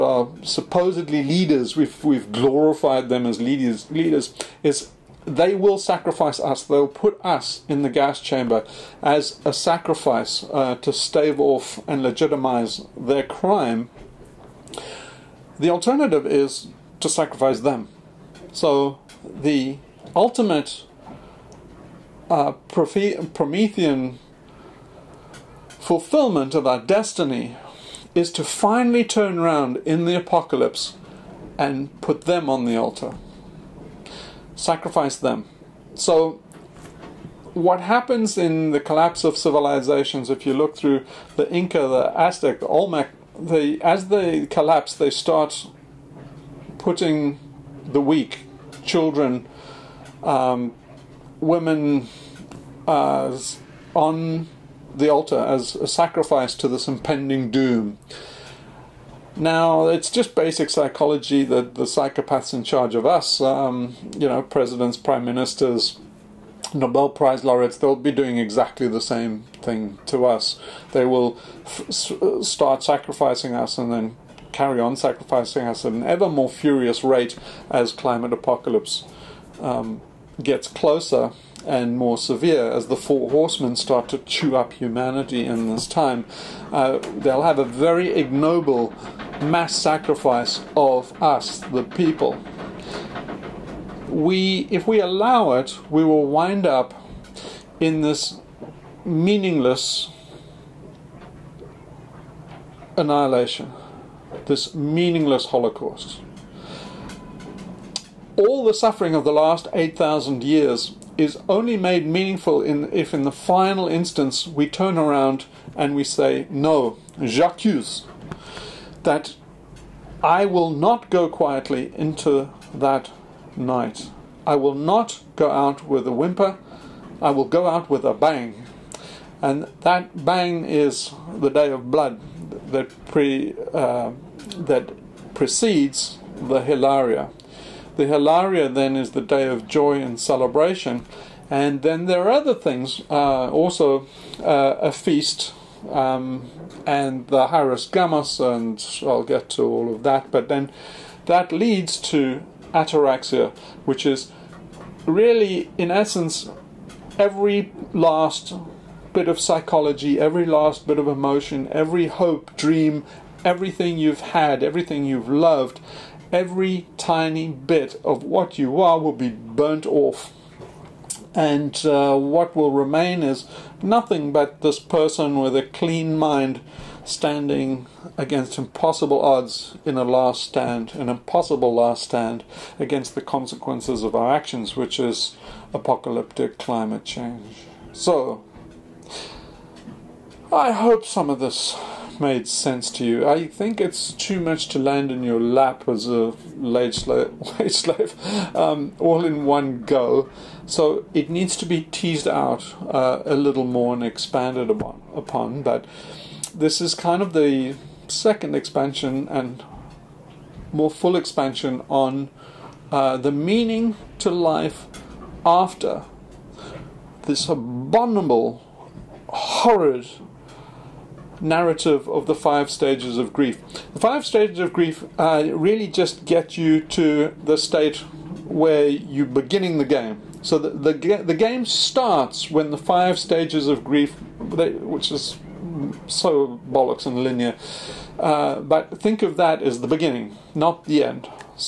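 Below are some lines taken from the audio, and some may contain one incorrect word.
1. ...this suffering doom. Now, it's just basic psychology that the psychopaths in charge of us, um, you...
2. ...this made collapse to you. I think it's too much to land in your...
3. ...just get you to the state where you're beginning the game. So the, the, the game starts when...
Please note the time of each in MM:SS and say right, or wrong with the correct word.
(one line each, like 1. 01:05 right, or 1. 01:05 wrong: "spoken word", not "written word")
1. 00:56 wrong: "impending", not "suffering"
2. 03:11 wrong: "sense", not "collapse"
3. 03:45 right.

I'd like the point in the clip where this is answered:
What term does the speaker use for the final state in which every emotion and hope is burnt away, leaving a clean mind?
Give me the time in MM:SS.
02:32.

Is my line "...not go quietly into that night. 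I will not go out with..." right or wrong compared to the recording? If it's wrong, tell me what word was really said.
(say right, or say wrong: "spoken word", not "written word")
right.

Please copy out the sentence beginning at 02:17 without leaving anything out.
The Hilaria then is the day of joy and celebration.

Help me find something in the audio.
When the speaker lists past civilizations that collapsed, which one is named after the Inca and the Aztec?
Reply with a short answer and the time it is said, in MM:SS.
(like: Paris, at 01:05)
Olmec, at 00:42.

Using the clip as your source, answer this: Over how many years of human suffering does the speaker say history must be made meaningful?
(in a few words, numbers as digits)
8,000 years.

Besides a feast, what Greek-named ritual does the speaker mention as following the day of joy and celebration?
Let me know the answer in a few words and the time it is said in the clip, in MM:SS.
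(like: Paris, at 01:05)
hieros gamos, at 02:27.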